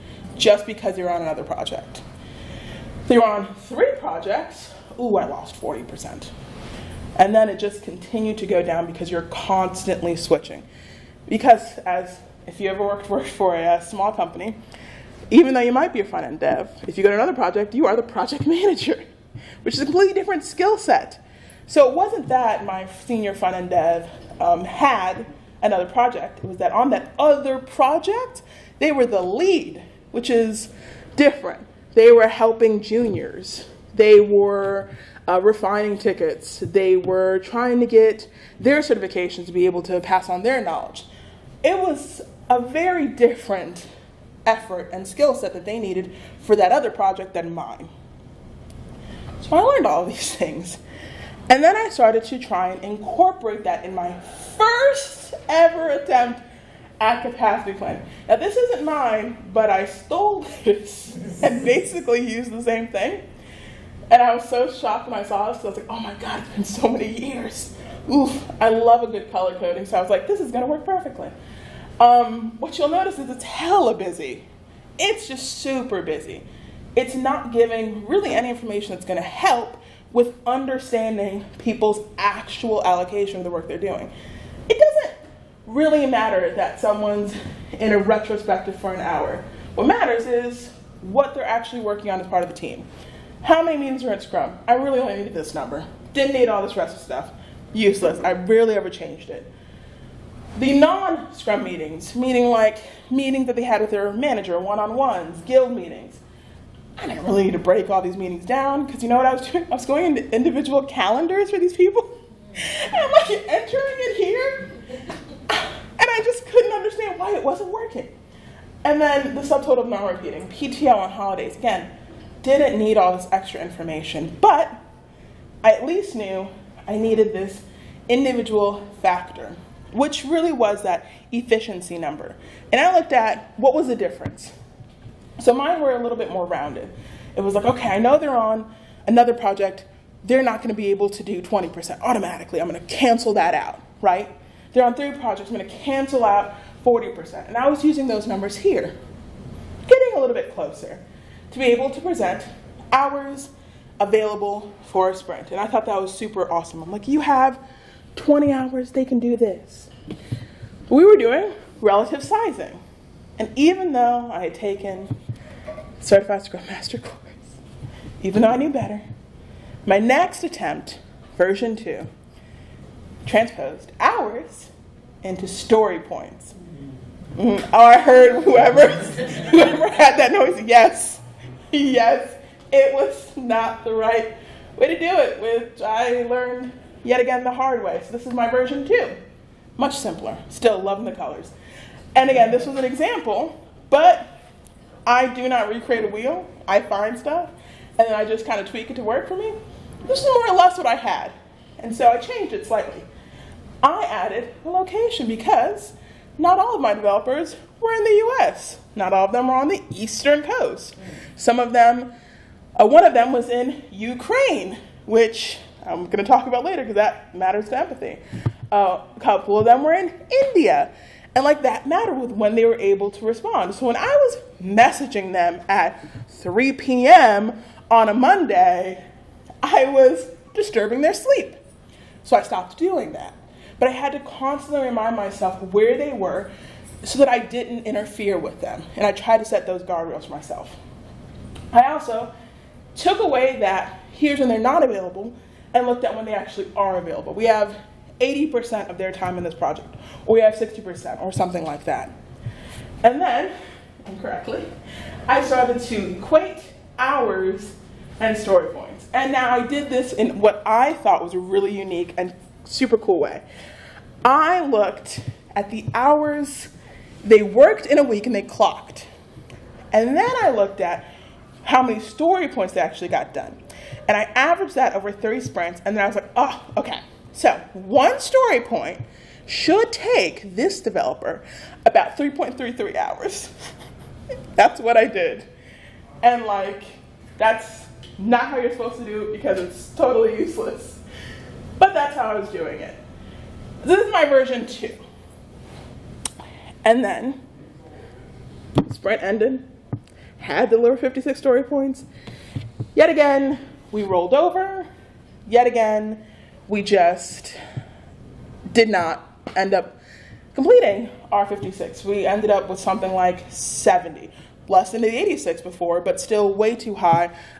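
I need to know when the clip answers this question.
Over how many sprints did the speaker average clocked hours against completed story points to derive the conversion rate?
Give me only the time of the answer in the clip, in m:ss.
4:35.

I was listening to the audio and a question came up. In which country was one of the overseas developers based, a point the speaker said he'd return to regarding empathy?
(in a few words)
Ukraine.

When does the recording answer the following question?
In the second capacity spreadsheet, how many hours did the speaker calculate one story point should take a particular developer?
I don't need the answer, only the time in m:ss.
4:42.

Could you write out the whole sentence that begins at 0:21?
So it wasn't that my senior front-end dev um, had another project.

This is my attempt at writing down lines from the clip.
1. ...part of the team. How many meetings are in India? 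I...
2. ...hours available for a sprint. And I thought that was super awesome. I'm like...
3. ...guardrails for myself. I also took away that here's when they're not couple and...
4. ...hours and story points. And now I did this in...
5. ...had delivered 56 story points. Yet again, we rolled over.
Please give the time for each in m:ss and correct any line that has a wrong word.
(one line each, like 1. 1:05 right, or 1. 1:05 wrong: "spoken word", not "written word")
1. 1:32 wrong: "Scrum", not "India"
2. 2:32 right
3. 3:59 wrong: "available", not "couple"
4. 4:16 right
5. 5:00 right.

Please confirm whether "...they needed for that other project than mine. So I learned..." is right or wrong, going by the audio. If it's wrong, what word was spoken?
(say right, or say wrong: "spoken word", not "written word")
right.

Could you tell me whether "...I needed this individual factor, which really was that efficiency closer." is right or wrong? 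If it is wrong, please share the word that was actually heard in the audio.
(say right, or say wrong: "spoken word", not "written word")
wrong: "number", not "closer".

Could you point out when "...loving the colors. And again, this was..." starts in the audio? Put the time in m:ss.
3:10.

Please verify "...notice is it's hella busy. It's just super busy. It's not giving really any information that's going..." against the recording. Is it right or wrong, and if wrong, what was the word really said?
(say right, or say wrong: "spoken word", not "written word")
right.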